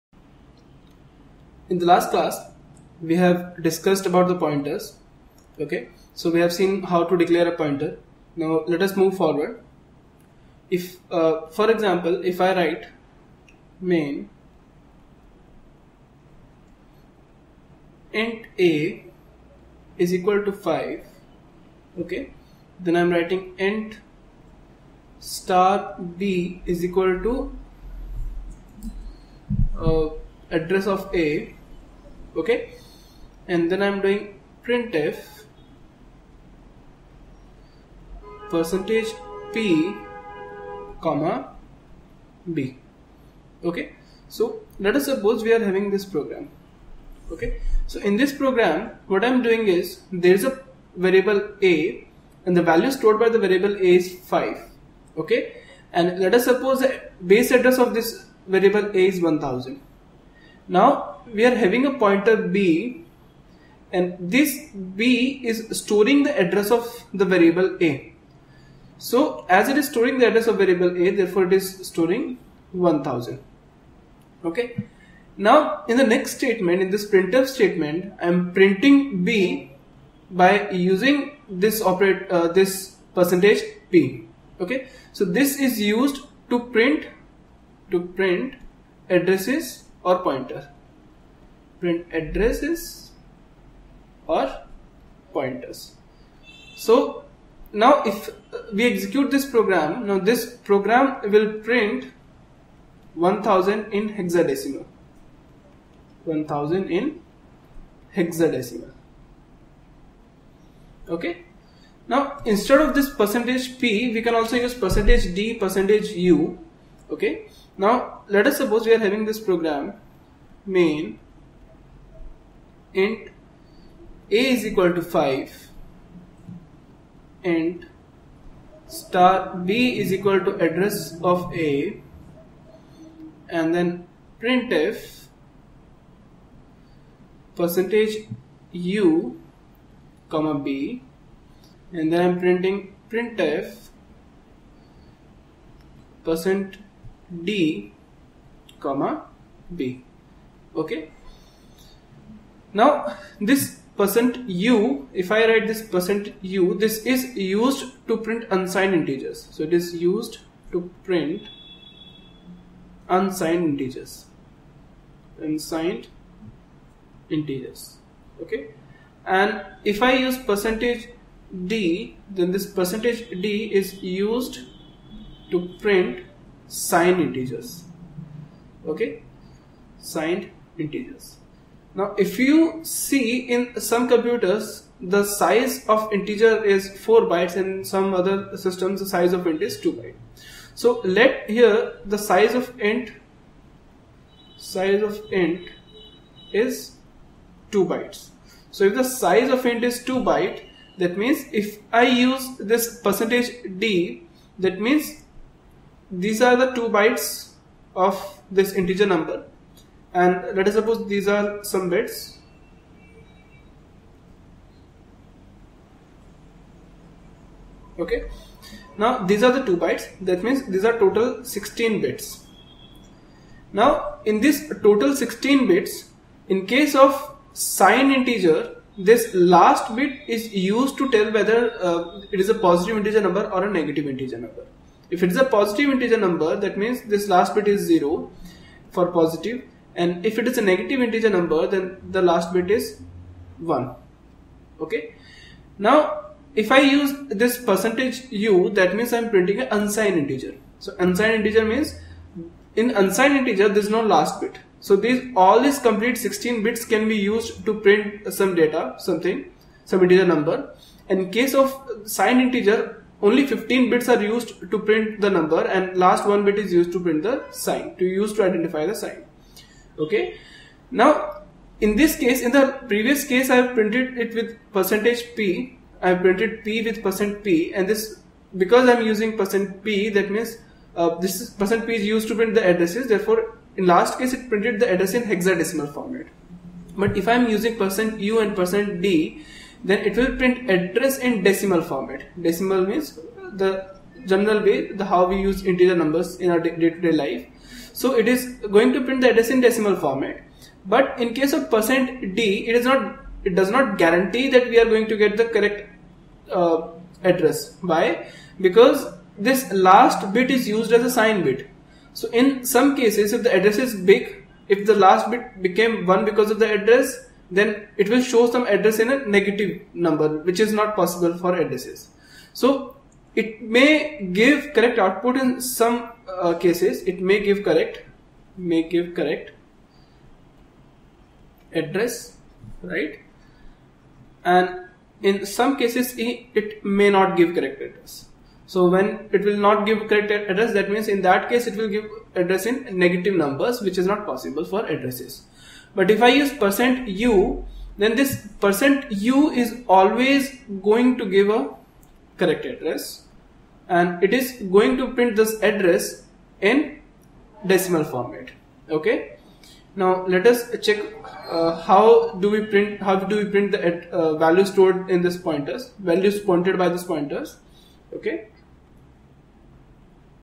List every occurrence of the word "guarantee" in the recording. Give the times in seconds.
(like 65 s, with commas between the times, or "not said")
304 s.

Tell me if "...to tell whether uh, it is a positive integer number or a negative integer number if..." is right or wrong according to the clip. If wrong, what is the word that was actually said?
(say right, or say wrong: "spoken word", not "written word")
right.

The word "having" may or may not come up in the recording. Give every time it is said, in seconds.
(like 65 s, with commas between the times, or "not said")
45 s, 61 s, 119 s.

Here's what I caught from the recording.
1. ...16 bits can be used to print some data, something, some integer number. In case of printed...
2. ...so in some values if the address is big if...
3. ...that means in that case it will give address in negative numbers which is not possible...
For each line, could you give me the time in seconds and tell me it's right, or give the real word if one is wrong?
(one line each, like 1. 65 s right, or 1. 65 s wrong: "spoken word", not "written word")
1. 256 s wrong: "signed", not "printed"
2. 312 s wrong: "cases", not "values"
3. 340 s right.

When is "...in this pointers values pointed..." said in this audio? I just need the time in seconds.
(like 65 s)
365 s.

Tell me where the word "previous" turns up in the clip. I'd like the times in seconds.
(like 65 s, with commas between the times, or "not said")
272 s.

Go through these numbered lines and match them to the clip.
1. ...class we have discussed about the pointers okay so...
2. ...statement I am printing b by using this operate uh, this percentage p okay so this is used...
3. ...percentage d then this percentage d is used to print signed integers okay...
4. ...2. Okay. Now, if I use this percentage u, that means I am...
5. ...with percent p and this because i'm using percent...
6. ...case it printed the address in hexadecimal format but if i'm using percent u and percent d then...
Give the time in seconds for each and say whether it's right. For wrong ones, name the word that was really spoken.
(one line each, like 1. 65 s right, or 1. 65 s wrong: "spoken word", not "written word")
1. 2 s right
2. 77 s right
3. 170 s right
4. 243 s wrong: "1", not "2"
5. 276 s right
6. 284 s right.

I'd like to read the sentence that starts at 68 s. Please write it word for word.
So as it is storing the address of variable a therefore it is storing 1000.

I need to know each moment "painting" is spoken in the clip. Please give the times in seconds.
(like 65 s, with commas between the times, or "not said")
not said.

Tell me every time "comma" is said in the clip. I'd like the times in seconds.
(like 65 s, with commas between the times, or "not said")
41 s, 140 s, 148 s.